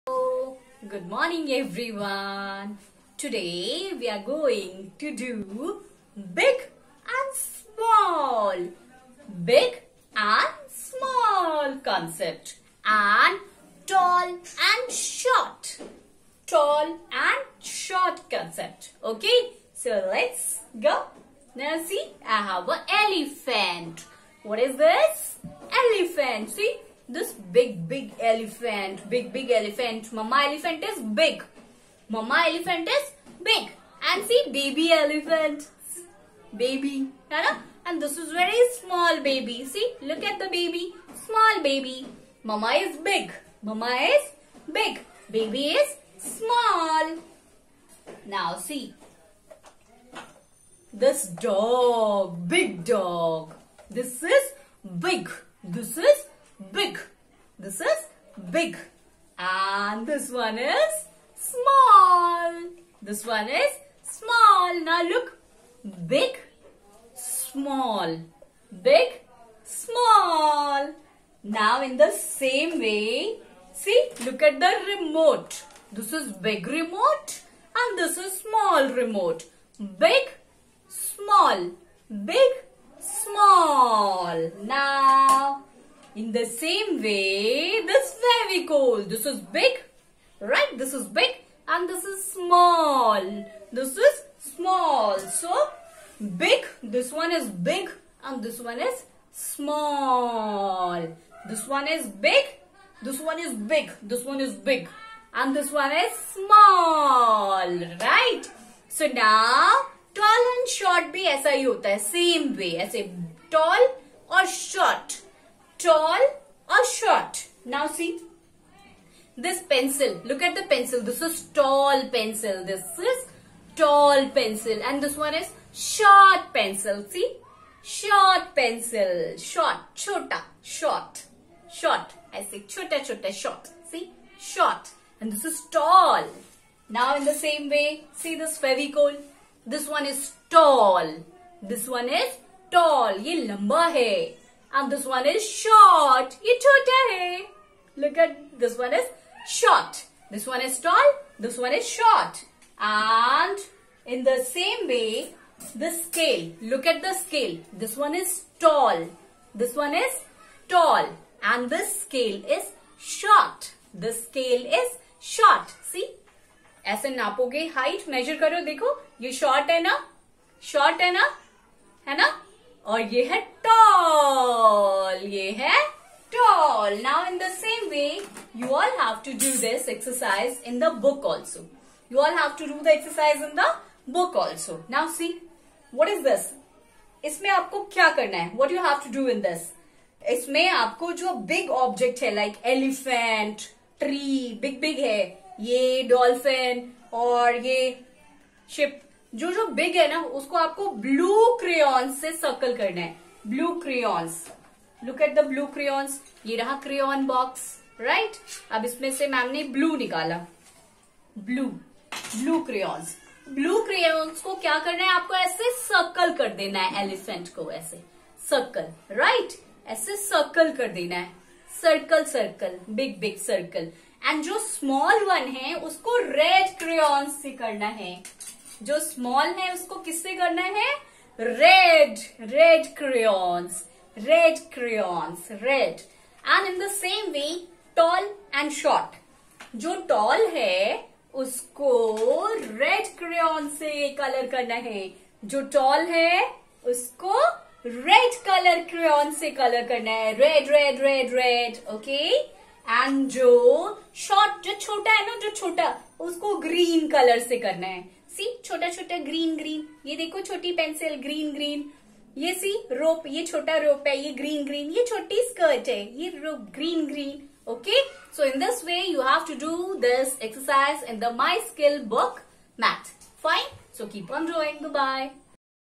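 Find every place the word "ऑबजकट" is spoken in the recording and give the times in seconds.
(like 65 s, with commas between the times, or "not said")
191 s.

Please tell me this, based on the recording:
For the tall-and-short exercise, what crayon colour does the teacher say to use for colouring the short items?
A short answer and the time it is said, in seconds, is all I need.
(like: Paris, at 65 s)
Green, at 256 s.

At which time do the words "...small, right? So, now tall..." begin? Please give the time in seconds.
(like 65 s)
106 s.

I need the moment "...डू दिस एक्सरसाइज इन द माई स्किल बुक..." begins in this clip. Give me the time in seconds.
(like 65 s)
269 s.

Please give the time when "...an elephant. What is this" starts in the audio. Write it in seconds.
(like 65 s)
22 s.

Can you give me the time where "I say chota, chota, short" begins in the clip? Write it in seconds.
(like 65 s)
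132 s.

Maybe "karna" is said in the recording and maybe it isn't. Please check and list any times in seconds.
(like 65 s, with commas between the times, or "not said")
244 s, 249 s, 257 s.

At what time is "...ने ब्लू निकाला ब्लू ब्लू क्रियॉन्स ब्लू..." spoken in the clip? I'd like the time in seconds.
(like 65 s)
209 s.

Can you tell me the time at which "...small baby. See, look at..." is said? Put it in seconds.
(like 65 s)
38 s.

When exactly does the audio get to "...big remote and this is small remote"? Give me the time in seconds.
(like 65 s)
76 s.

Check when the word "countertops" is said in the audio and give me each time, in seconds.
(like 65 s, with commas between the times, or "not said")
not said.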